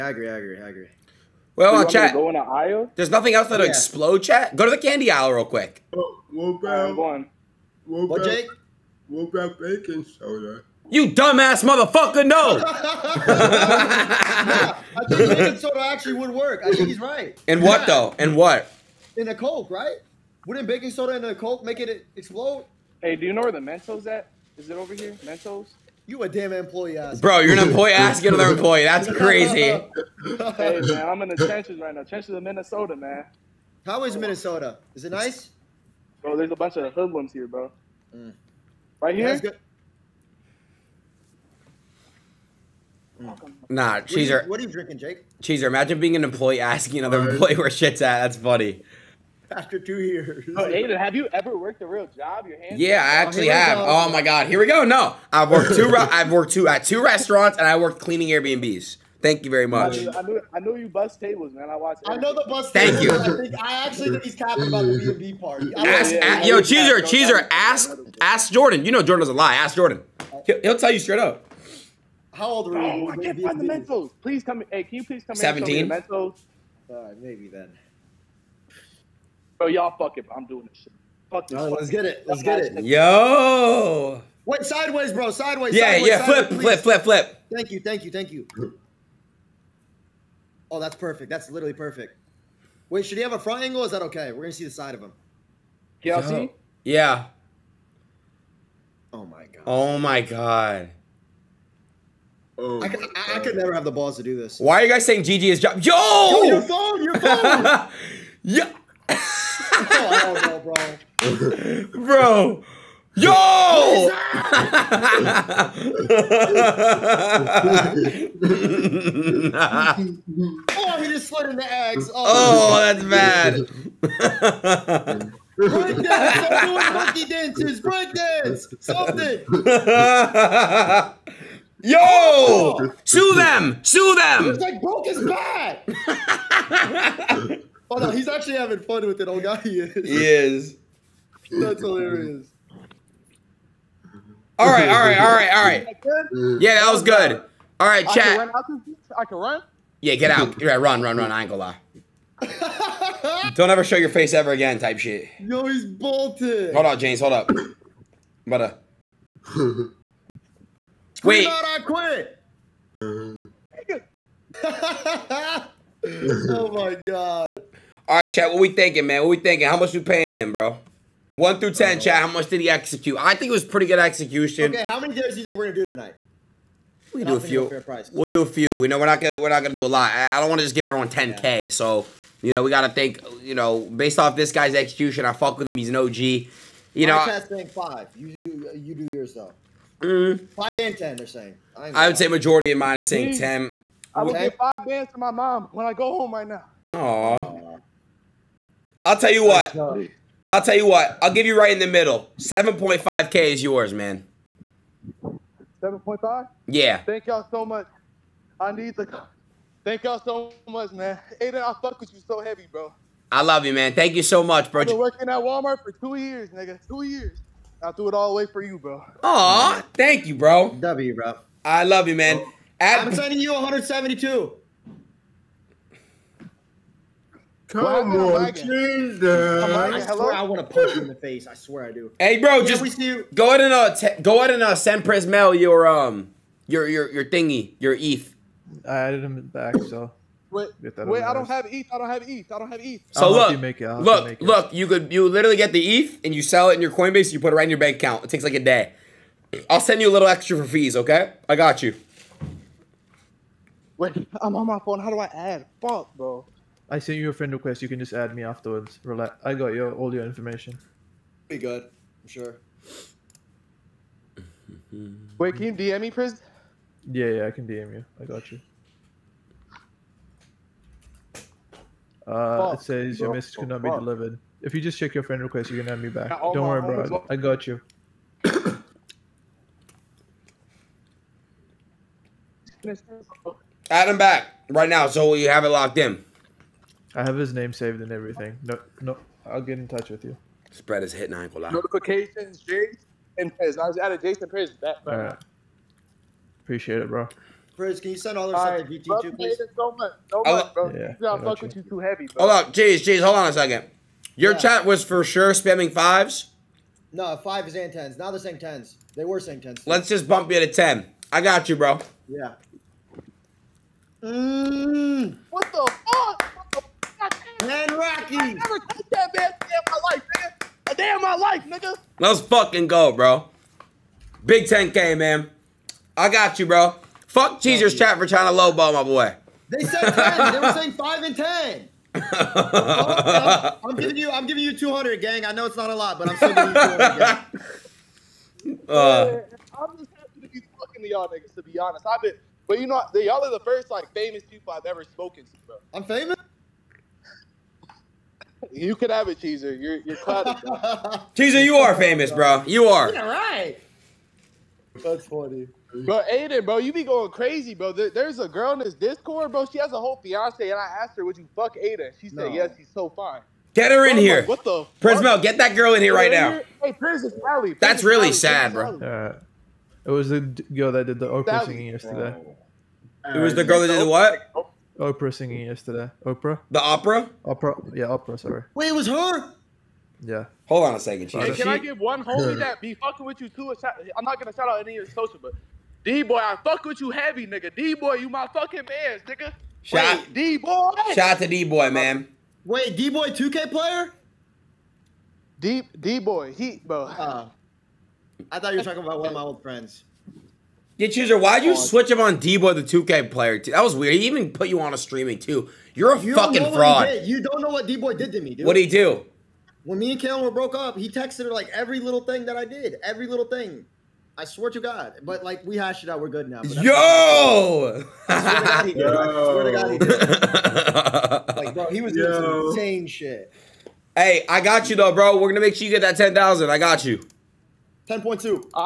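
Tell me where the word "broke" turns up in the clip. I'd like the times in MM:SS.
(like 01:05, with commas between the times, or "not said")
02:14, 06:50.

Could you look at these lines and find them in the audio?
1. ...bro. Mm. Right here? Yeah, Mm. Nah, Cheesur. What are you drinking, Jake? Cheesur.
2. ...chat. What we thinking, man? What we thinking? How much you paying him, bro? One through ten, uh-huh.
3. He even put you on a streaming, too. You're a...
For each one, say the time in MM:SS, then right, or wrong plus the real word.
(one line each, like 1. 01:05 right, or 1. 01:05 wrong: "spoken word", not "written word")
1. 00:37 right
2. 02:48 right
3. 06:44 right.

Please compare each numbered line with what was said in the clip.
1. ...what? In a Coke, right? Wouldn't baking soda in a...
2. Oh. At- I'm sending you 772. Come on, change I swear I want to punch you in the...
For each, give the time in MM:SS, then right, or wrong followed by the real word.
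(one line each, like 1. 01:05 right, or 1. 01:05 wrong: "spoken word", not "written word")
1. 00:18 right
2. 03:42 wrong: "172", not "772".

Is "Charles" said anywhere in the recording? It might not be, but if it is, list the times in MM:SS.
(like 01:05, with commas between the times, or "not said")
not said.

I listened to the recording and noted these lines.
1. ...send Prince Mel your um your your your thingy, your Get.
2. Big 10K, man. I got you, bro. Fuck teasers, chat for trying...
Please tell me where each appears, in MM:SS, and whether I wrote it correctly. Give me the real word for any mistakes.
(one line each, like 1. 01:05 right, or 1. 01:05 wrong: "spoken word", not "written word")
1. 03:54 wrong: "ETH", not "Get"
2. 05:24 right.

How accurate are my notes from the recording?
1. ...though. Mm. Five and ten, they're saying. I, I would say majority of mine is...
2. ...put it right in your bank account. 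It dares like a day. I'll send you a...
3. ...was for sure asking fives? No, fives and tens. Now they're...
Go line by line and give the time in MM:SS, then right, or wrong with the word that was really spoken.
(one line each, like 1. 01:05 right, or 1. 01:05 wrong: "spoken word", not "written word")
1. 03:09 right
2. 04:07 wrong: "takes", not "dares"
3. 05:04 wrong: "spamming", not "asking".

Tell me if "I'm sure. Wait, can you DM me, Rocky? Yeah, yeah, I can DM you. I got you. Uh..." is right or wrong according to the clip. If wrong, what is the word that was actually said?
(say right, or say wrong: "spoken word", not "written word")
wrong: "Priz", not "Rocky".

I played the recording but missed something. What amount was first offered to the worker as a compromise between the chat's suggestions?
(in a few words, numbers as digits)
7.5K.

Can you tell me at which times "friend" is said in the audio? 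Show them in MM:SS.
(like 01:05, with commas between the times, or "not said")
04:17, 04:35, 06:39.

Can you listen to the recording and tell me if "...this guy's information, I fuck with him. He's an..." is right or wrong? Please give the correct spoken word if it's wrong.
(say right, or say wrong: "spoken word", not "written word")
wrong: "execution", not "information".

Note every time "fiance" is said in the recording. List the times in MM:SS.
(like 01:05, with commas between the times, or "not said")
06:00.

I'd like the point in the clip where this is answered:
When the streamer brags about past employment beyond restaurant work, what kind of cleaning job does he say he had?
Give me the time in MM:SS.
00:58.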